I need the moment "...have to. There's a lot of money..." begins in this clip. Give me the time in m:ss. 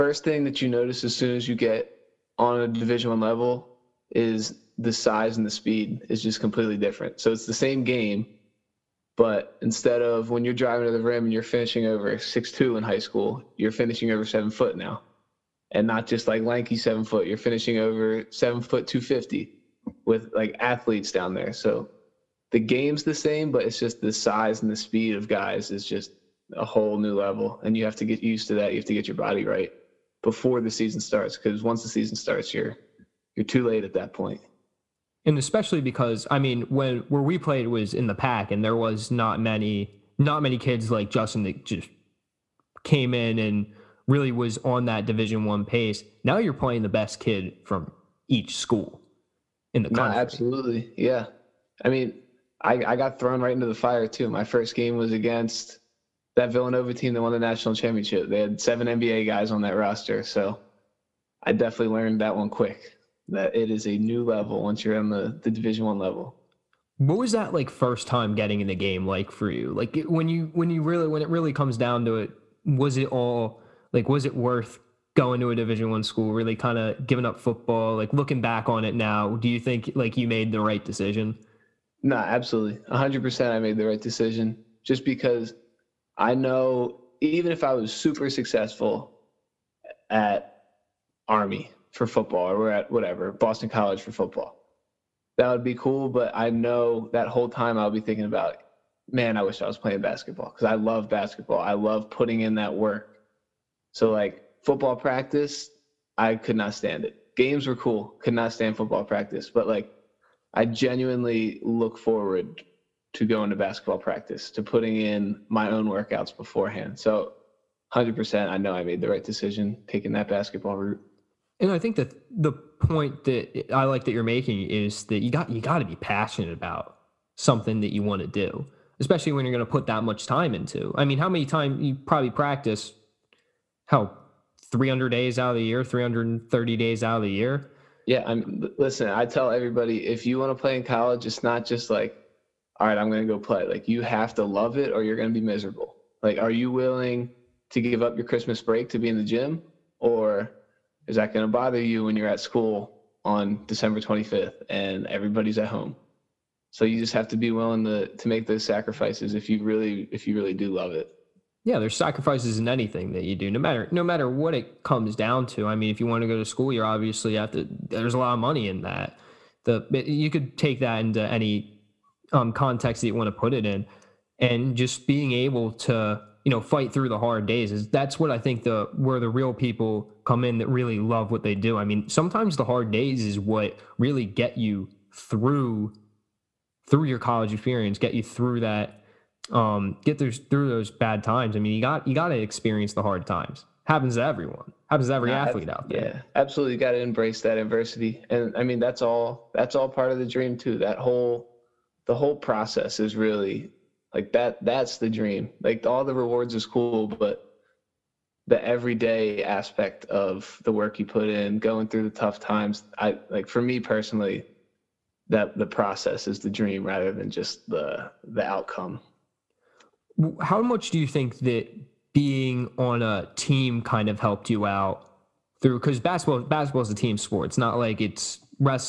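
2:47.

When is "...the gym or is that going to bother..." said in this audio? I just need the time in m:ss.
2:29.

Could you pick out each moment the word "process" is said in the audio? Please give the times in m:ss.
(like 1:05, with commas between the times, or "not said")
3:22, 3:35.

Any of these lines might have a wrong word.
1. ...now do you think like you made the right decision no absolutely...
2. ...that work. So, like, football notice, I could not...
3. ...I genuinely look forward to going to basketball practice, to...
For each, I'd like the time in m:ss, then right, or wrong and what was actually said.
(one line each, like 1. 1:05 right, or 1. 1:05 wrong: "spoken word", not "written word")
1. 1:18 right
2. 1:42 wrong: "practice", not "notice"
3. 1:50 right.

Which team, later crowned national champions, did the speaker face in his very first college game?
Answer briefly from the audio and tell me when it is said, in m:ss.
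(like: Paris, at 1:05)
Villanova, at 0:56.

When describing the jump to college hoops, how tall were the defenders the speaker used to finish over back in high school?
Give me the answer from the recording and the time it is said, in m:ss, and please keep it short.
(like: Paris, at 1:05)
6'2", at 0:12.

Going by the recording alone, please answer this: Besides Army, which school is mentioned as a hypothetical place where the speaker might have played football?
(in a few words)
Boston College.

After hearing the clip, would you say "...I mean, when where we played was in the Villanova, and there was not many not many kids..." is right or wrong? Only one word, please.
wrong.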